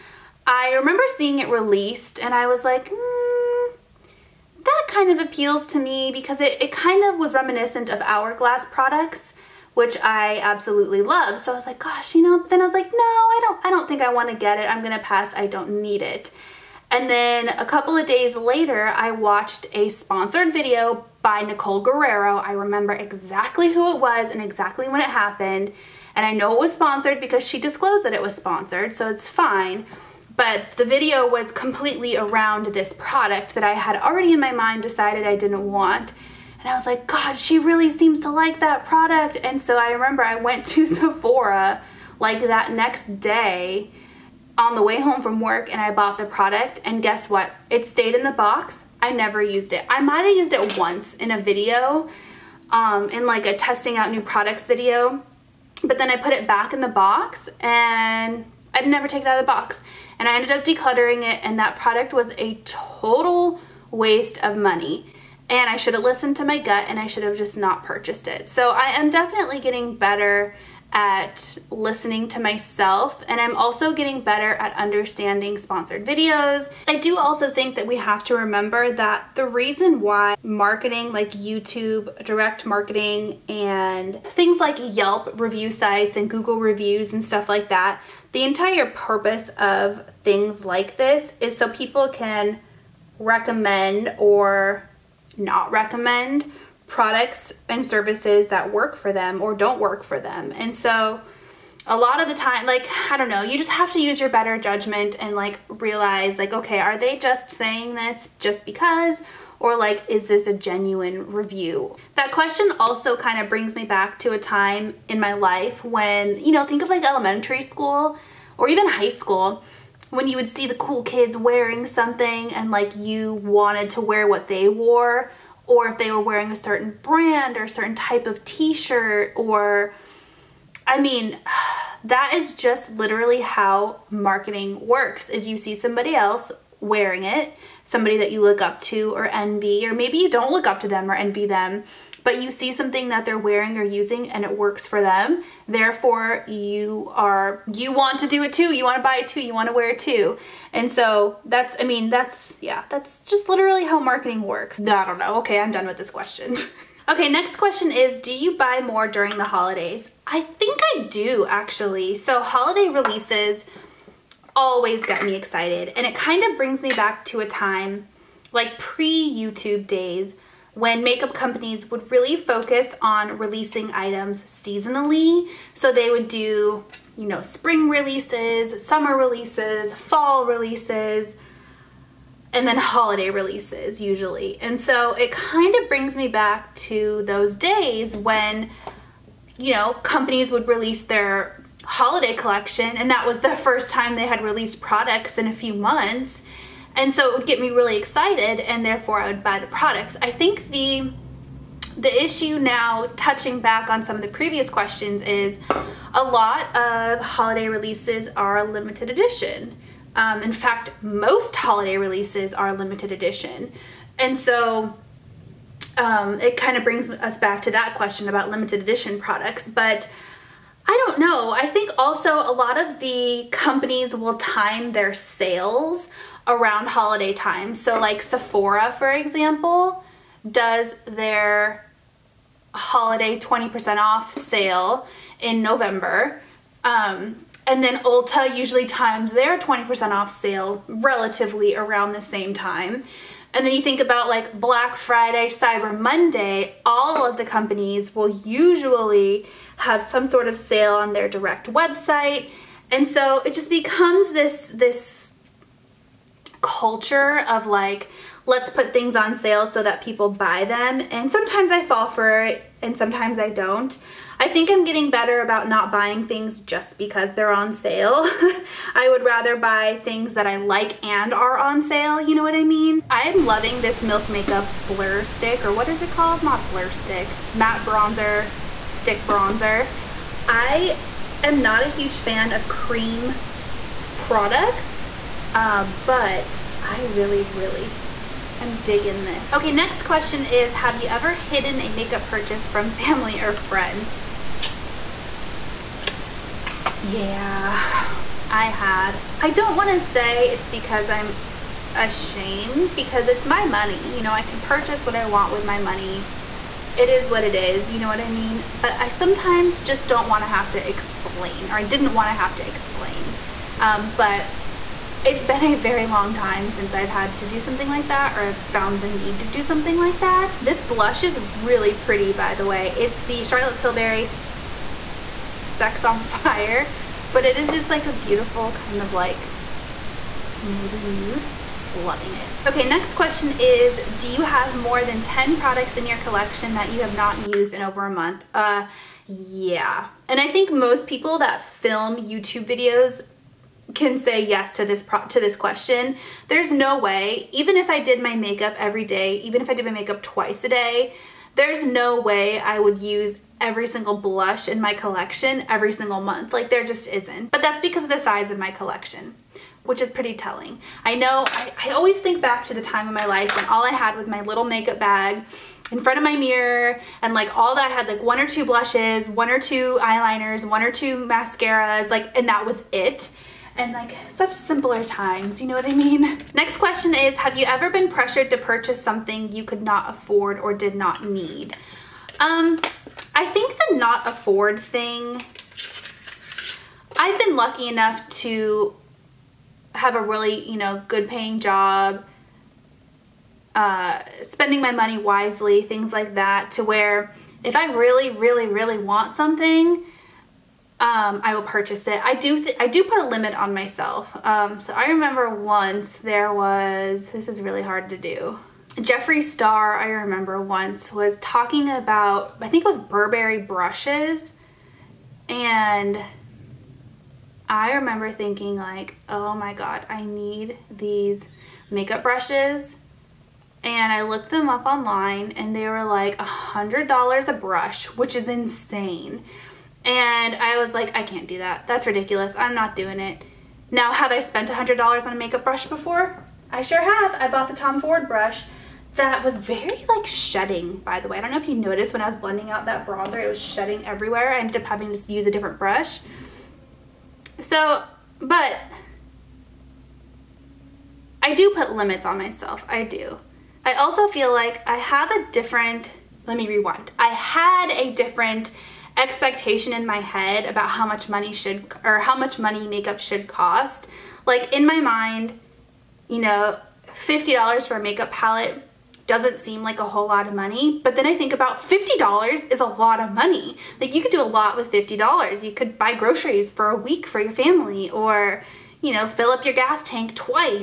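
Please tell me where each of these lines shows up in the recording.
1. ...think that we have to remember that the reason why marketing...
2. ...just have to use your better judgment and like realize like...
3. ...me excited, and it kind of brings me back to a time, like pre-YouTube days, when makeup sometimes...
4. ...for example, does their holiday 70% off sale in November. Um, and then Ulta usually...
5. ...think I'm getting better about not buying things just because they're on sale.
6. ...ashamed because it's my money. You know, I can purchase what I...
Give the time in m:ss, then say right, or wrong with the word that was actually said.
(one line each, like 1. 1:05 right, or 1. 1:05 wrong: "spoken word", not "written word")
1. 1:17 right
2. 1:43 right
3. 2:45 wrong: "companies", not "sometimes"
4. 3:48 wrong: "20", not "70"
5. 4:24 right
6. 5:01 right.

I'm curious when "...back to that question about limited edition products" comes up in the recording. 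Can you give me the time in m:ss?
3:37.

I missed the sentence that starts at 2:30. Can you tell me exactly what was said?
And so that's, I mean, that's, yeah, that's just literally how marketing works.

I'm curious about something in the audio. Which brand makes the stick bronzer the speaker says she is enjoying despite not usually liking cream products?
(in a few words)
Milk Makeup.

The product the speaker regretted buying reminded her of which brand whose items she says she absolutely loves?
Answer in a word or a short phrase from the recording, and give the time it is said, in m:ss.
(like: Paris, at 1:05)
Hourglass, at 0:08.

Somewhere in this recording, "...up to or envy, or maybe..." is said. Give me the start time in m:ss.
2:18.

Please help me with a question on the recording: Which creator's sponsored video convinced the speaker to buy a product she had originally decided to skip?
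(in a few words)
Nicole Guerrero.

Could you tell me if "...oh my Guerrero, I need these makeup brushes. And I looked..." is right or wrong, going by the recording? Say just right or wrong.
wrong.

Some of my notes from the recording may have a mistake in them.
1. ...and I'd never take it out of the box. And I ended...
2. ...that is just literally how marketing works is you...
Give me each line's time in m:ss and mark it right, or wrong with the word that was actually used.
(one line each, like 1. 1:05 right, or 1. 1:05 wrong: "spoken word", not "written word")
1. 0:57 right
2. 2:12 right.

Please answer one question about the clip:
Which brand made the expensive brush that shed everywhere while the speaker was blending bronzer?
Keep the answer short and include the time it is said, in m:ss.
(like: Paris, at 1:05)
Tom Ford, at 7:17.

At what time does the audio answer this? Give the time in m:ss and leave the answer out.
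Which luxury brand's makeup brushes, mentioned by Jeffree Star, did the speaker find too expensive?
6:52.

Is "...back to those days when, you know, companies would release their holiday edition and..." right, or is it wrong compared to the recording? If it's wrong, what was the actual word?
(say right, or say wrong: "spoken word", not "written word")
wrong: "collection", not "edition".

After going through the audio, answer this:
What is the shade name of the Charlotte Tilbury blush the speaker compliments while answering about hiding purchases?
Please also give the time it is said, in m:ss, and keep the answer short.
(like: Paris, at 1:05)
Sex on Fire, at 5:24.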